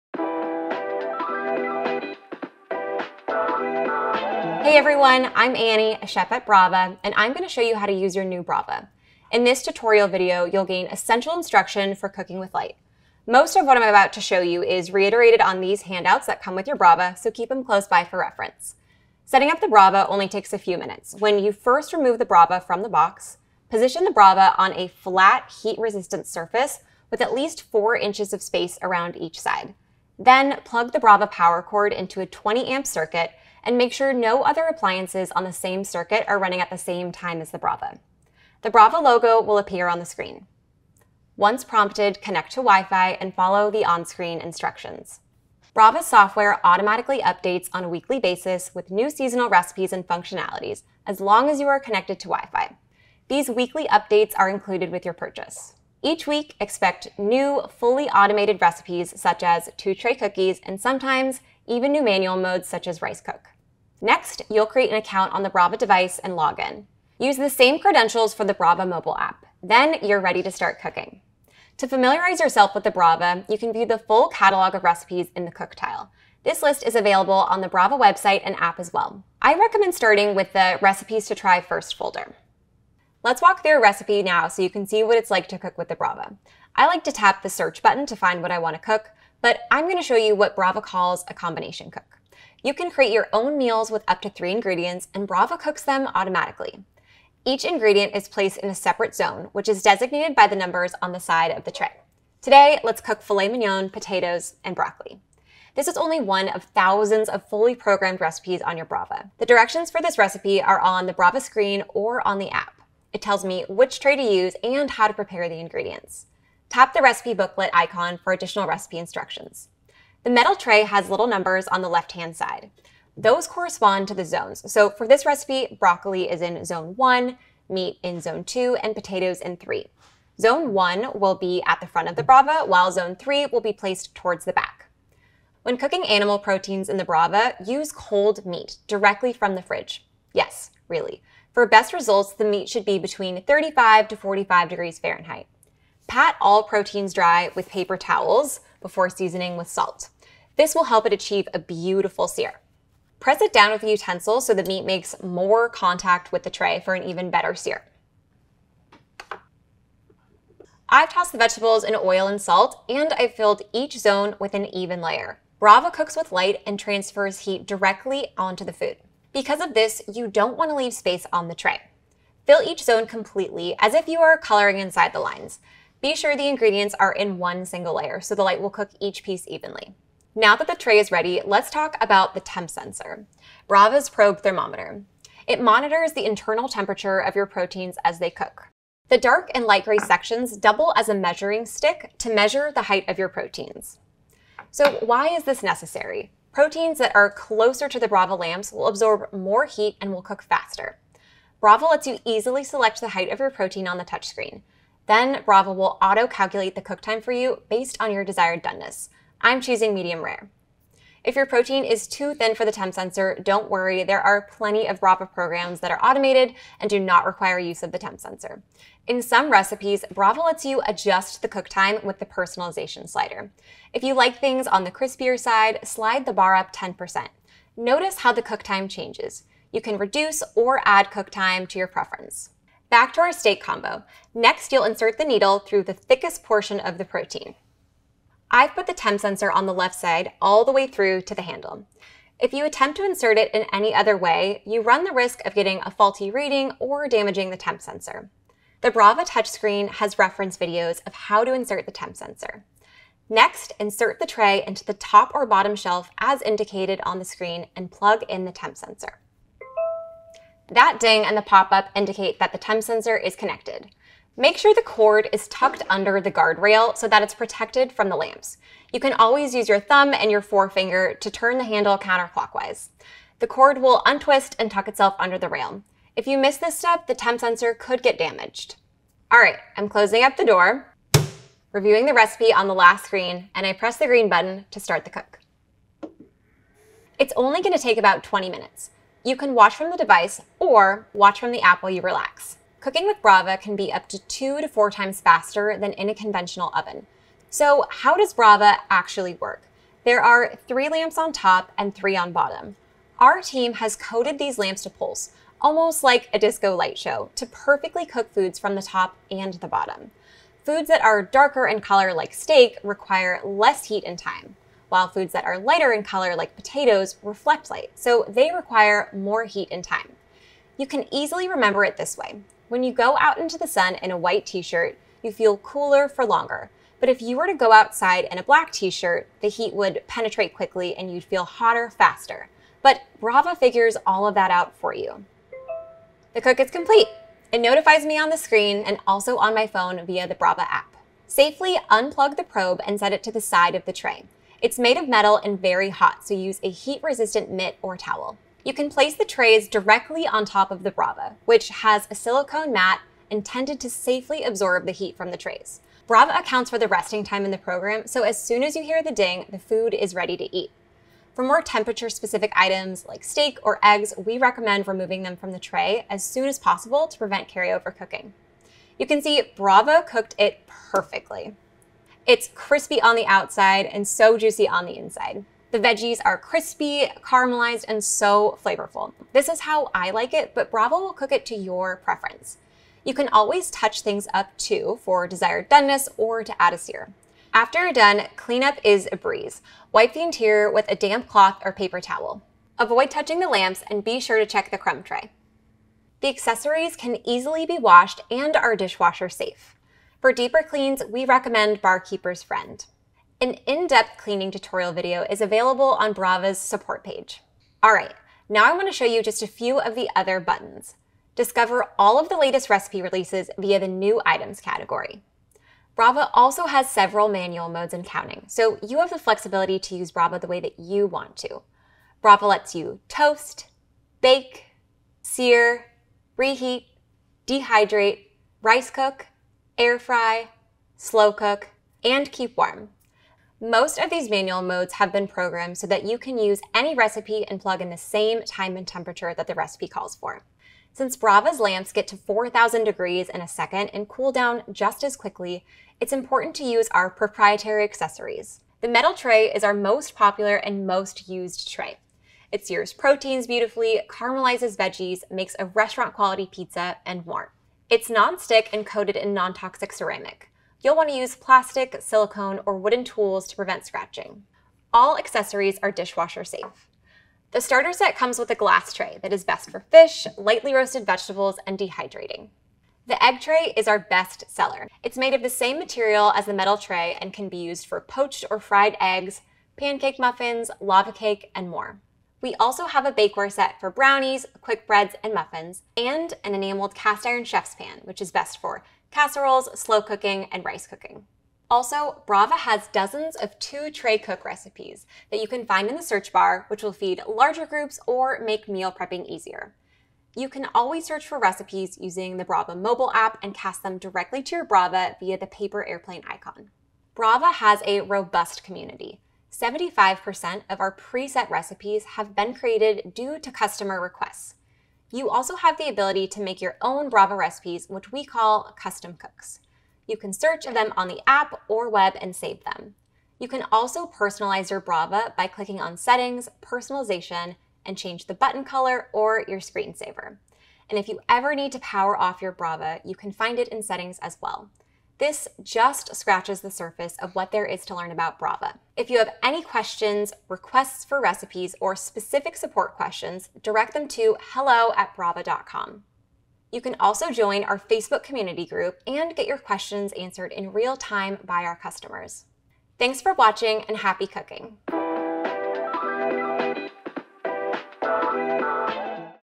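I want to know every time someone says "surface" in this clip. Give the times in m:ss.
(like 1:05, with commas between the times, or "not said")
0:26, 8:56.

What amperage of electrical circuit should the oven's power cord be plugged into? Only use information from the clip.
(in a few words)
20 amp.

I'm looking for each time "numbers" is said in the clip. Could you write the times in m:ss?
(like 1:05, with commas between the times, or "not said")
1:40, 2:01.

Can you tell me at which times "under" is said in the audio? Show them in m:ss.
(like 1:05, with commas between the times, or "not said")
4:25, 4:35.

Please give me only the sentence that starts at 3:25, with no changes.
Then Brava will auto-calculate the cook time for you based on your desired doneness, I'm choosing medium rare.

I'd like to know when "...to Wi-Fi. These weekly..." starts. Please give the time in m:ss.
0:52.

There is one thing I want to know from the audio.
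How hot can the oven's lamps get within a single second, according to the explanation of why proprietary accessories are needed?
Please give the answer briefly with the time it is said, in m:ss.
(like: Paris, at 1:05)
4,000 degrees, at 7:22.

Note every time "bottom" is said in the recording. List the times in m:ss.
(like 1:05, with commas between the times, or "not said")
4:15, 5:02, 5:09.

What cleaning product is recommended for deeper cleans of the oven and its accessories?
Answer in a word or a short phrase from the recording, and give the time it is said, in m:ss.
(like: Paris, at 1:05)
Barkeeper's Friend, at 6:41.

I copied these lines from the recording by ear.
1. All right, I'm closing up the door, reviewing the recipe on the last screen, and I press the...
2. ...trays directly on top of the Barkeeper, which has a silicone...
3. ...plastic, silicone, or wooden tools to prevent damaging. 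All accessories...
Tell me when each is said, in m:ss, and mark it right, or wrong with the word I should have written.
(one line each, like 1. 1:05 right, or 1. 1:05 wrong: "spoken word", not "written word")
1. 4:39 right
2. 5:49 wrong: "Brava", not "Barkeeper"
3. 7:41 wrong: "scratching", not "damaging".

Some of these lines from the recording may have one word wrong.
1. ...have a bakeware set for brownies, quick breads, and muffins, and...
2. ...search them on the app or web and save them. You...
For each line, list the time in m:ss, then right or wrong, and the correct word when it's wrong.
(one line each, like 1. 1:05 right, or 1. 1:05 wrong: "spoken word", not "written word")
1. 8:02 right
2. 8:40 right.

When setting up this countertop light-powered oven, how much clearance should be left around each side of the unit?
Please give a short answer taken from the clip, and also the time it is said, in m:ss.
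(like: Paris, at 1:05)
4 inches, at 0:27.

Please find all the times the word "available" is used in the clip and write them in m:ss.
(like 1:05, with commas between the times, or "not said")
1:16, 6:45.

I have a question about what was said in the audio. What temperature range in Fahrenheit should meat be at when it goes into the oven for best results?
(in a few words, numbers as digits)
35 to 45 degrees.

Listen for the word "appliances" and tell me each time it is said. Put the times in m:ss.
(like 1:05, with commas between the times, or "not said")
0:34.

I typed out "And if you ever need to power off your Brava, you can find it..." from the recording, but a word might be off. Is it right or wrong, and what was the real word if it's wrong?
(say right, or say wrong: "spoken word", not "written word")
right.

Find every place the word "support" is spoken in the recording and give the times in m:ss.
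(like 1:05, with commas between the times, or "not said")
6:46, 9:02.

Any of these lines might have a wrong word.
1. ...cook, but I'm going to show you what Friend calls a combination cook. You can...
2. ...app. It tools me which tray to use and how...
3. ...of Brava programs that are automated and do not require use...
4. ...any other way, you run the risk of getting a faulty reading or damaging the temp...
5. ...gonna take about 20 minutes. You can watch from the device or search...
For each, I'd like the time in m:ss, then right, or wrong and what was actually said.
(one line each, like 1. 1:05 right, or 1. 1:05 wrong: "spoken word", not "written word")
1. 1:28 wrong: "Brava", not "Friend"
2. 1:52 wrong: "tells", not "tools"
3. 3:34 right
4. 4:03 right
5. 4:47 wrong: "watch", not "search".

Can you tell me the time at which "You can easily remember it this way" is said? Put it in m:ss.
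5:20.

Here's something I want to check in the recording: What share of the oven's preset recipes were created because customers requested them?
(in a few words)
75%.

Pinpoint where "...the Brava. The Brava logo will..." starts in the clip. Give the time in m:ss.
0:37.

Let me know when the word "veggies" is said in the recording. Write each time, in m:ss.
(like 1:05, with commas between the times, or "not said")
6:15, 7:34.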